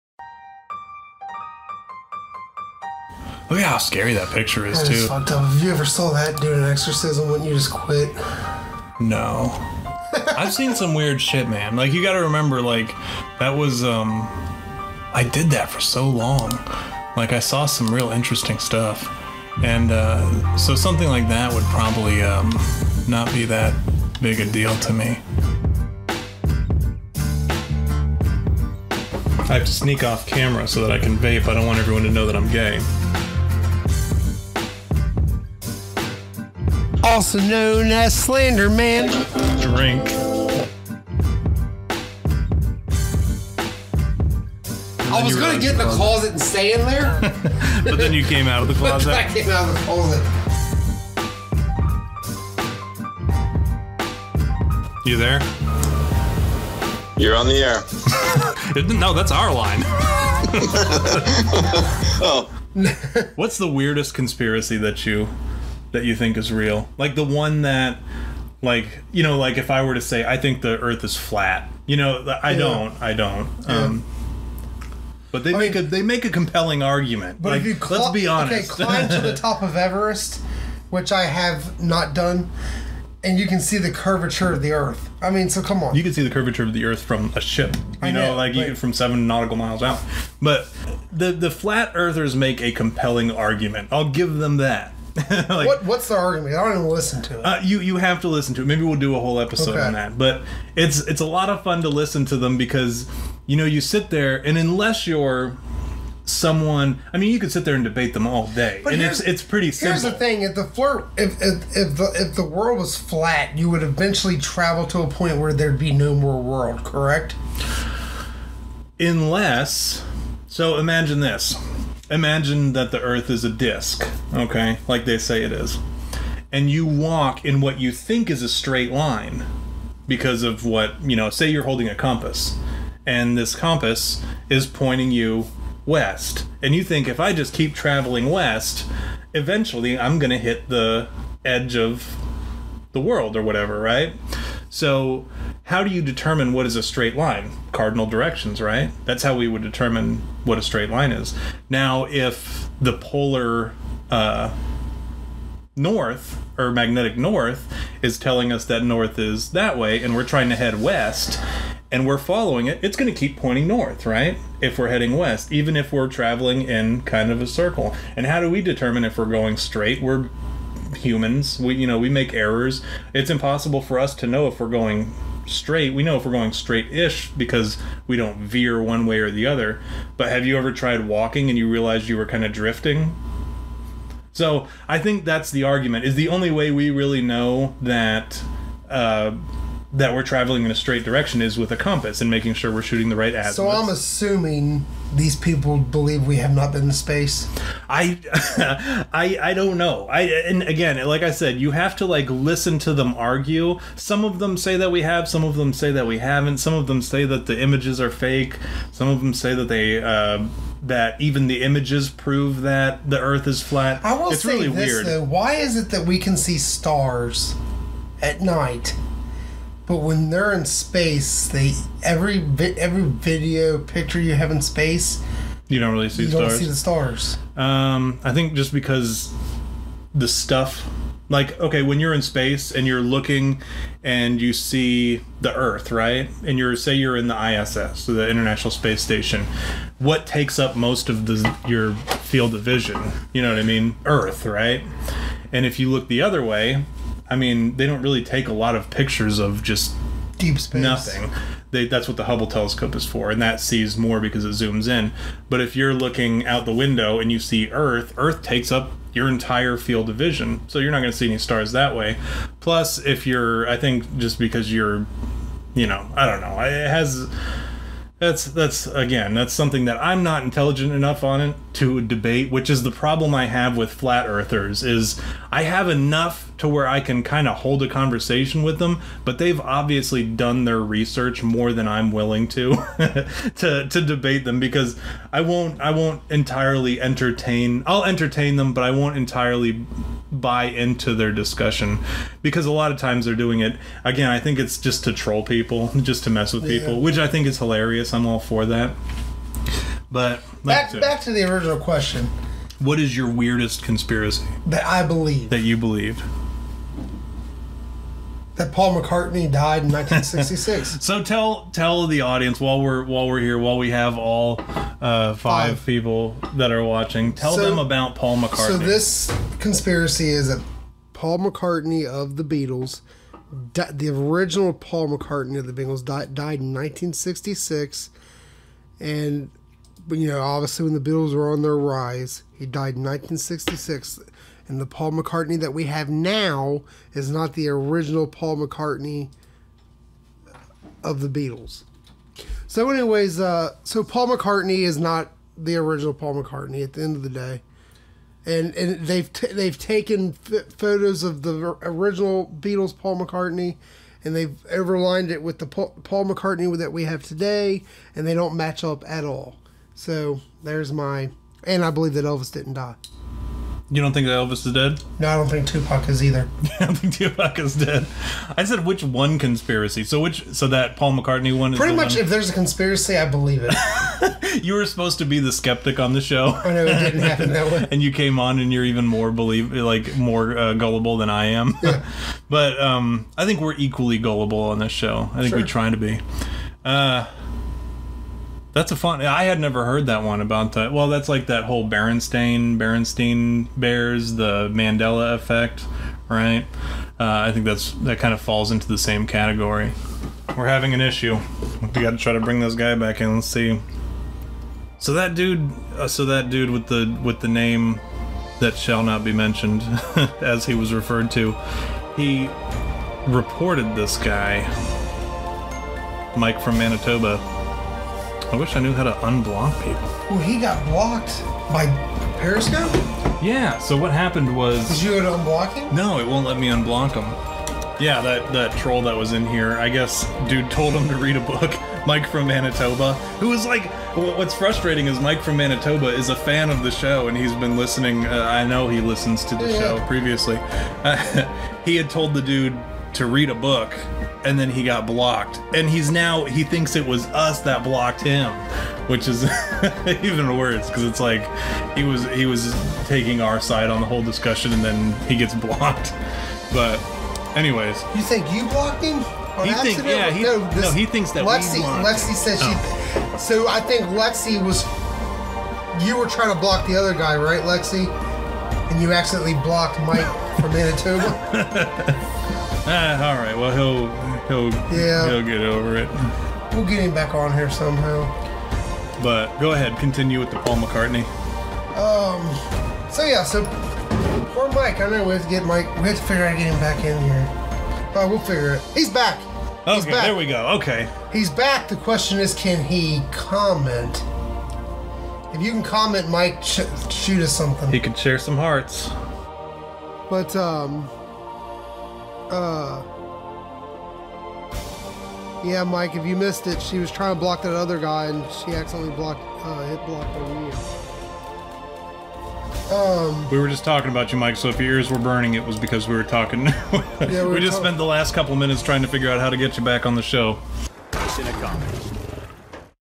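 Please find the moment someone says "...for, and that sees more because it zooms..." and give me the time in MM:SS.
04:13.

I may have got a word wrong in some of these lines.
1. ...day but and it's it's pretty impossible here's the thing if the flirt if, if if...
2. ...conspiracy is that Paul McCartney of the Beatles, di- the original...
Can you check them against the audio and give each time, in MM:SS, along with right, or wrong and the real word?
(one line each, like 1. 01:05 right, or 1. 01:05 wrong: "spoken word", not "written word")
1. 01:48 wrong: "simple", not "impossible"
2. 05:19 right.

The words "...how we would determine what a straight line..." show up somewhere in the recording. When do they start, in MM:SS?
02:29.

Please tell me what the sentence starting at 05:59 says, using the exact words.
So there's my, and I believe that Elvis didn't die.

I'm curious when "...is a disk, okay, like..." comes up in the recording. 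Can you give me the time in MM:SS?
02:03.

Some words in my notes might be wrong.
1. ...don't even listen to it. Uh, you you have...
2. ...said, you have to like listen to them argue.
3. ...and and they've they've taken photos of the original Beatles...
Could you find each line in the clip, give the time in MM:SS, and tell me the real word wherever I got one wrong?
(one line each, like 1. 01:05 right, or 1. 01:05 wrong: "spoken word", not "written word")
1. 01:36 right
2. 03:21 right
3. 05:48 right.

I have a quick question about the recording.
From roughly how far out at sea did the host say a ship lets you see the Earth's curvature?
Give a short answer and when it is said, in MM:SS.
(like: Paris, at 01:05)
7 nautical miles, at 01:28.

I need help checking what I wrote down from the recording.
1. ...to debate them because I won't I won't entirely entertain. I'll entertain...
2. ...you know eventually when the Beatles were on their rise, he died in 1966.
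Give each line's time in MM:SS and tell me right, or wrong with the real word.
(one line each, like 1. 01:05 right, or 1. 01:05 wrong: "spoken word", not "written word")
1. 04:43 right
2. 05:30 wrong: "obviously", not "eventually".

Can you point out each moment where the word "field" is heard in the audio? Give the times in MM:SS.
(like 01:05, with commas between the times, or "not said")
04:02, 04:19.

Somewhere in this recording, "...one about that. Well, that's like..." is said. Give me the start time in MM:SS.
06:30.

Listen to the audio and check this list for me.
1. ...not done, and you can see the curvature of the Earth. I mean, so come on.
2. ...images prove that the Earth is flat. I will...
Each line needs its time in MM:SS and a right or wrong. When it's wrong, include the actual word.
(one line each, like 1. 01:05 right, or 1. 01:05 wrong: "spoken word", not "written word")
1. 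01:21 right
2. 03:31 right.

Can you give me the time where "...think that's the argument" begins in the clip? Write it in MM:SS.
03:04.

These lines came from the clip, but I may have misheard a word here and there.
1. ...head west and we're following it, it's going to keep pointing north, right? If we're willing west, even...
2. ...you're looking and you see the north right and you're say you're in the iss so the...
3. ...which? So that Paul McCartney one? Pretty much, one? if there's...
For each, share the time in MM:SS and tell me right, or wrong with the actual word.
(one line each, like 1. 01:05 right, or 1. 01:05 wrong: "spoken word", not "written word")
1. 02:40 wrong: "heading", not "willing"
2. 03:52 wrong: "earth", not "north"
3. 06:10 right.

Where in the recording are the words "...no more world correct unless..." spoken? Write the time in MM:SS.
01:55.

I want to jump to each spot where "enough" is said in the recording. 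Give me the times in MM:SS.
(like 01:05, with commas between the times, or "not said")
04:30, 04:35.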